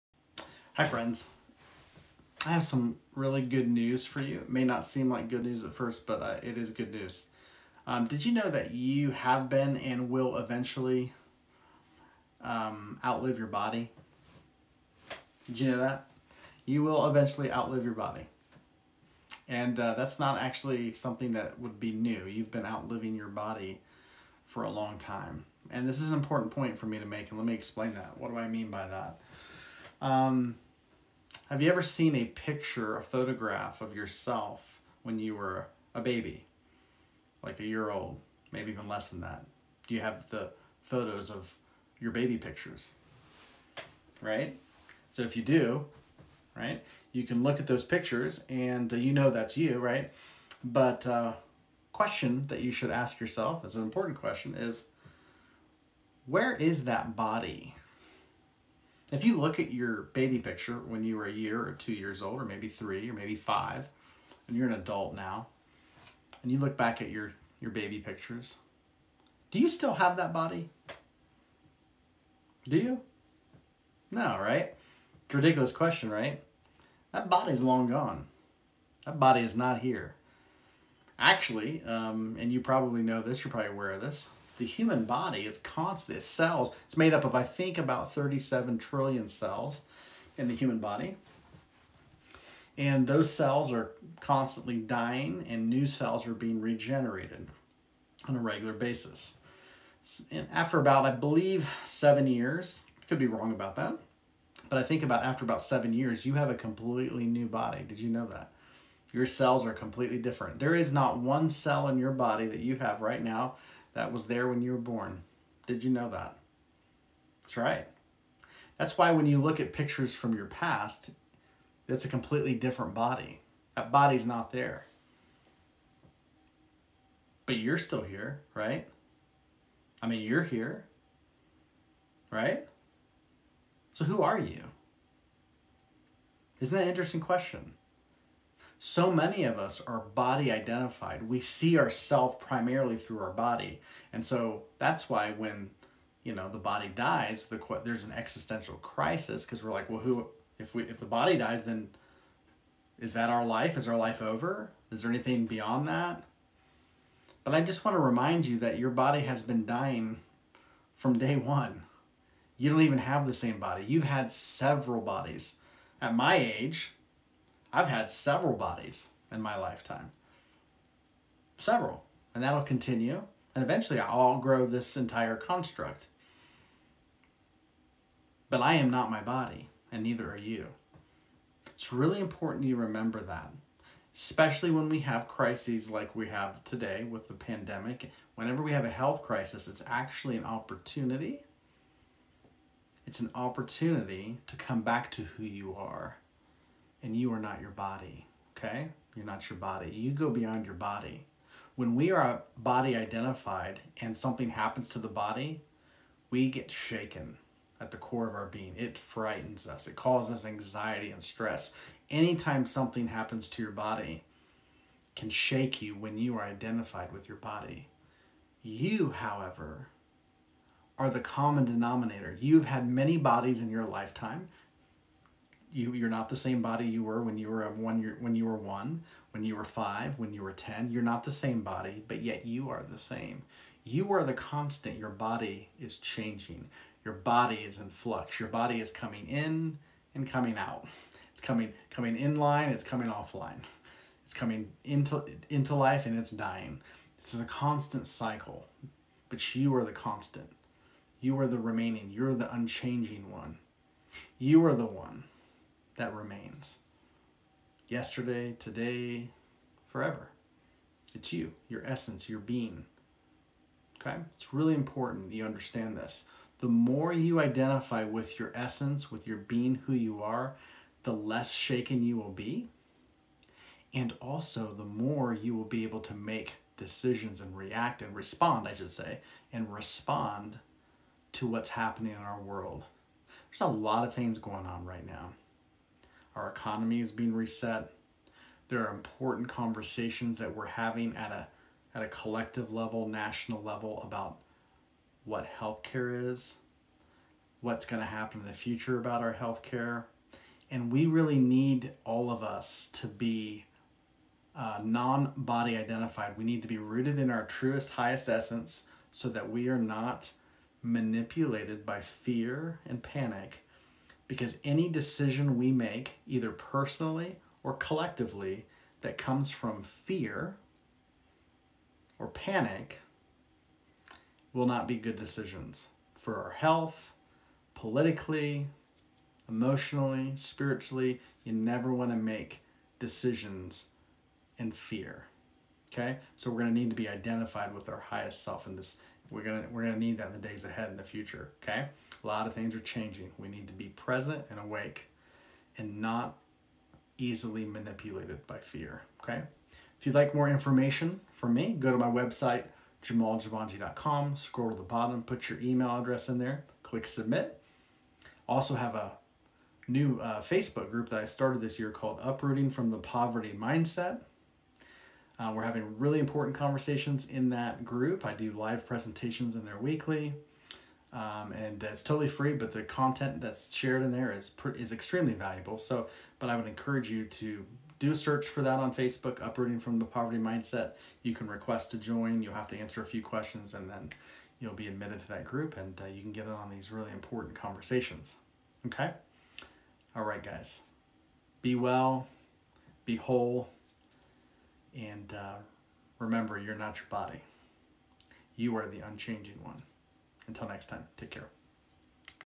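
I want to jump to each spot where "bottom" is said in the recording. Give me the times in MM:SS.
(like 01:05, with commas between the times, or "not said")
05:54.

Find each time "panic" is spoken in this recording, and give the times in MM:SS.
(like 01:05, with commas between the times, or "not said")
05:13, 05:22.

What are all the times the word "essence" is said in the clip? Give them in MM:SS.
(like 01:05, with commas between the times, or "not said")
04:21, 04:28, 05:08.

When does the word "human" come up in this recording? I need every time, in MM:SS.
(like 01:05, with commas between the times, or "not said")
01:24, 01:30.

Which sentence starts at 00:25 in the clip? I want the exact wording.
And this is an important point for me to make, and let me explain that.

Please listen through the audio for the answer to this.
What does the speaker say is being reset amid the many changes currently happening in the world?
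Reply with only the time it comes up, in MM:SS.
04:46.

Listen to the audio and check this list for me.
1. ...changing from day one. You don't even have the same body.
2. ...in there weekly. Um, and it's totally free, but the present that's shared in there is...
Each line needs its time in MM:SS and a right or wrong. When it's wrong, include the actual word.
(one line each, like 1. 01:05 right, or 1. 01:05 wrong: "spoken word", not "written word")
1. 02:39 wrong: "dying", not "changing"
2. 06:09 wrong: "content", not "present".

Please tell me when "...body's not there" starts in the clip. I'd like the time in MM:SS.
02:03.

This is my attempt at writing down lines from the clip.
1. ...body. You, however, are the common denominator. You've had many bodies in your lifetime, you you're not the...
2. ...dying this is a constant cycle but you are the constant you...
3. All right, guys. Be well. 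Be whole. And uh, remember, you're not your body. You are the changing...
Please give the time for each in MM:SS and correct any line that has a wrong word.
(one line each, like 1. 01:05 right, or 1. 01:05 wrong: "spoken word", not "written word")
1. 03:37 right
2. 04:06 right
3. 06:30 wrong: "unchanging", not "changing".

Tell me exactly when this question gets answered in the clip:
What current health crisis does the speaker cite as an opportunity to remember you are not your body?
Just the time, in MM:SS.
03:07.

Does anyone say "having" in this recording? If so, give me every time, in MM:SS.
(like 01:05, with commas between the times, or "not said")
04:50, 06:05.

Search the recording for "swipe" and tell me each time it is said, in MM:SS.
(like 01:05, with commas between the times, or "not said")
not said.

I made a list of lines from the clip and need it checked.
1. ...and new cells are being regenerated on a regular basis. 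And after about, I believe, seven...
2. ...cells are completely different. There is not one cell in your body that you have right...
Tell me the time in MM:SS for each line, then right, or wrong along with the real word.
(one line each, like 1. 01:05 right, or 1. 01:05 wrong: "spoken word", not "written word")
1. 01:35 right
2. 01:49 right.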